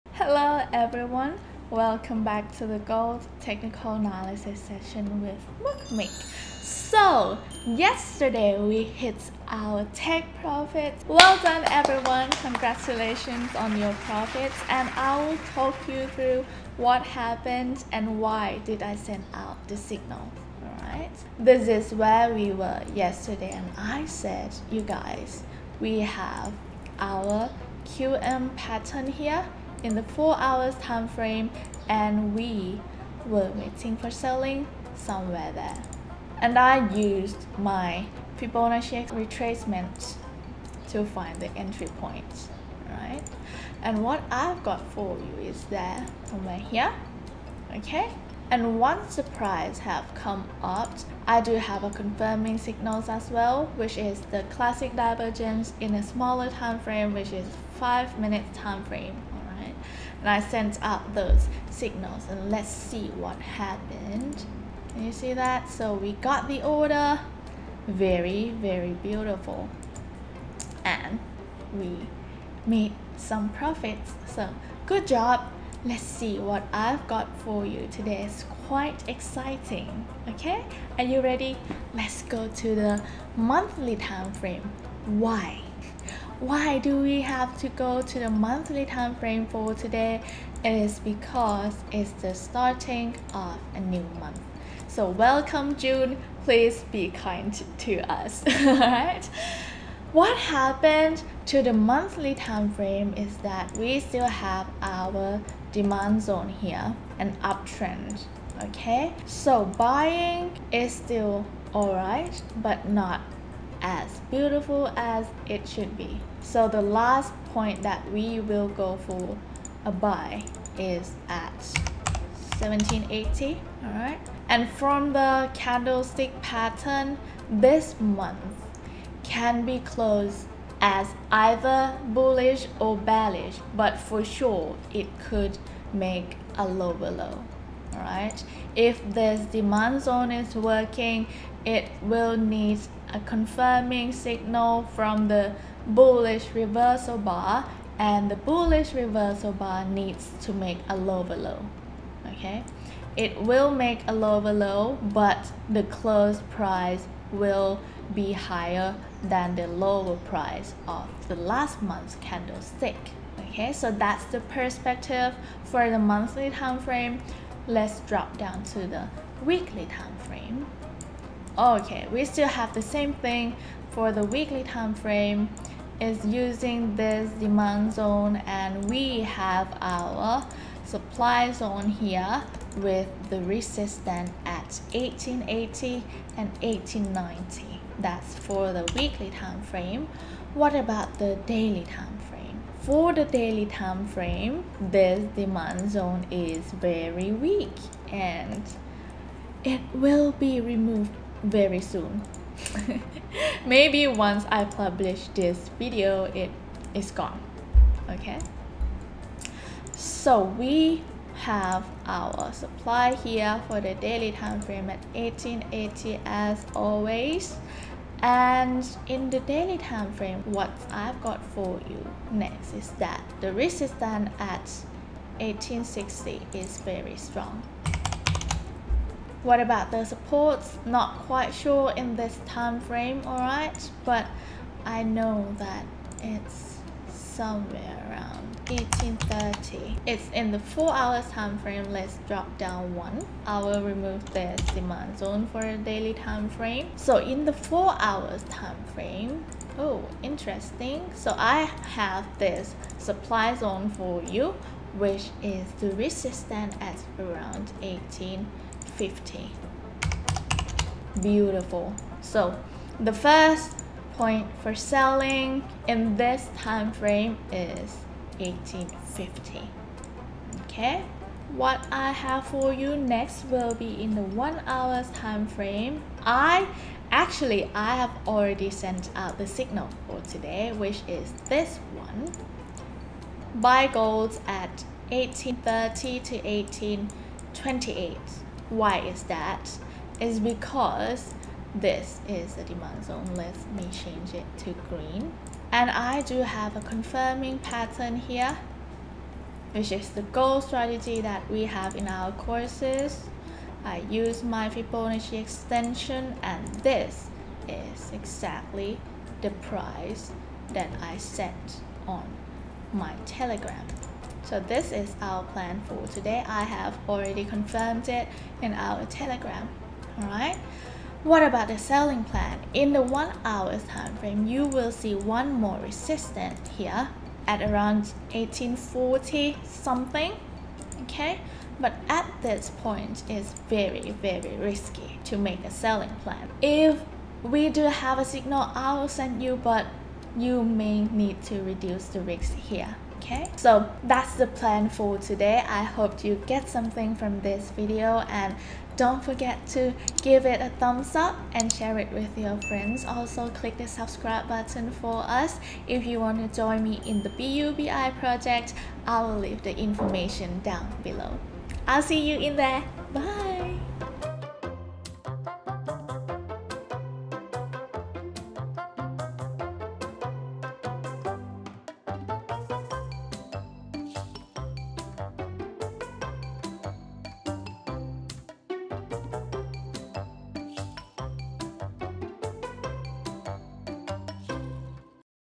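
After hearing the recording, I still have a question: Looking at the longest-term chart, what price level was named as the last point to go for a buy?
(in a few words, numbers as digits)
1780.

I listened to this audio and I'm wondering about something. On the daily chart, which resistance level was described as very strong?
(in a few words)
1860.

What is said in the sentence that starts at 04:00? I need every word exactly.
It's in the 4 hours time frame.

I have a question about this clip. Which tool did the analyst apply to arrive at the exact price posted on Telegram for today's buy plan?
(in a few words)
Fibonacci extension.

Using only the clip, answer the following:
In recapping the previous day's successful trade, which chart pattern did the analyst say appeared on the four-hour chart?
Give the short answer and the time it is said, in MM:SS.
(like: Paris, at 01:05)
QM pattern, at 00:27.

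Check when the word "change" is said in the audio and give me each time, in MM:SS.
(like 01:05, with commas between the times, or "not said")
04:53.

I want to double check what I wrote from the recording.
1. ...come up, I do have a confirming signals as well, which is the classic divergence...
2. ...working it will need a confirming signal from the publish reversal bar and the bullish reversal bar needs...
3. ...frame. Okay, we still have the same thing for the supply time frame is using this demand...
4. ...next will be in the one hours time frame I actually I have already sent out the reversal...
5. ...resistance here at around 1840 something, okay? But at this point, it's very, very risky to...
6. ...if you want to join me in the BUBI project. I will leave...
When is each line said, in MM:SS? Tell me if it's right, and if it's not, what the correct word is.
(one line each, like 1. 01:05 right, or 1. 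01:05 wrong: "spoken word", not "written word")
1. 00:50 right
2. 02:20 wrong: "bullish", not "publish"
3. 02:50 wrong: "weekly", not "supply"
4. 04:32 wrong: "signal", not "reversal"
5. 05:25 right
6. 05:55 right.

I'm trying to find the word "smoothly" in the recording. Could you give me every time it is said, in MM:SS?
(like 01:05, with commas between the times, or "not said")
not said.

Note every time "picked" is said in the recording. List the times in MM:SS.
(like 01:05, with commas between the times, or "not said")
not said.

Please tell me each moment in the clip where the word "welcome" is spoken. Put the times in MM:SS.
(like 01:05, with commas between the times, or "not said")
00:01, 01:35.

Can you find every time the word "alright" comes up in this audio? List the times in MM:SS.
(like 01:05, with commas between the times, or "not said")
00:20, 01:38, 01:51, 03:53, 05:20.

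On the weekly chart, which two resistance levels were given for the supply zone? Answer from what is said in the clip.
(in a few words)
1880 and 1890.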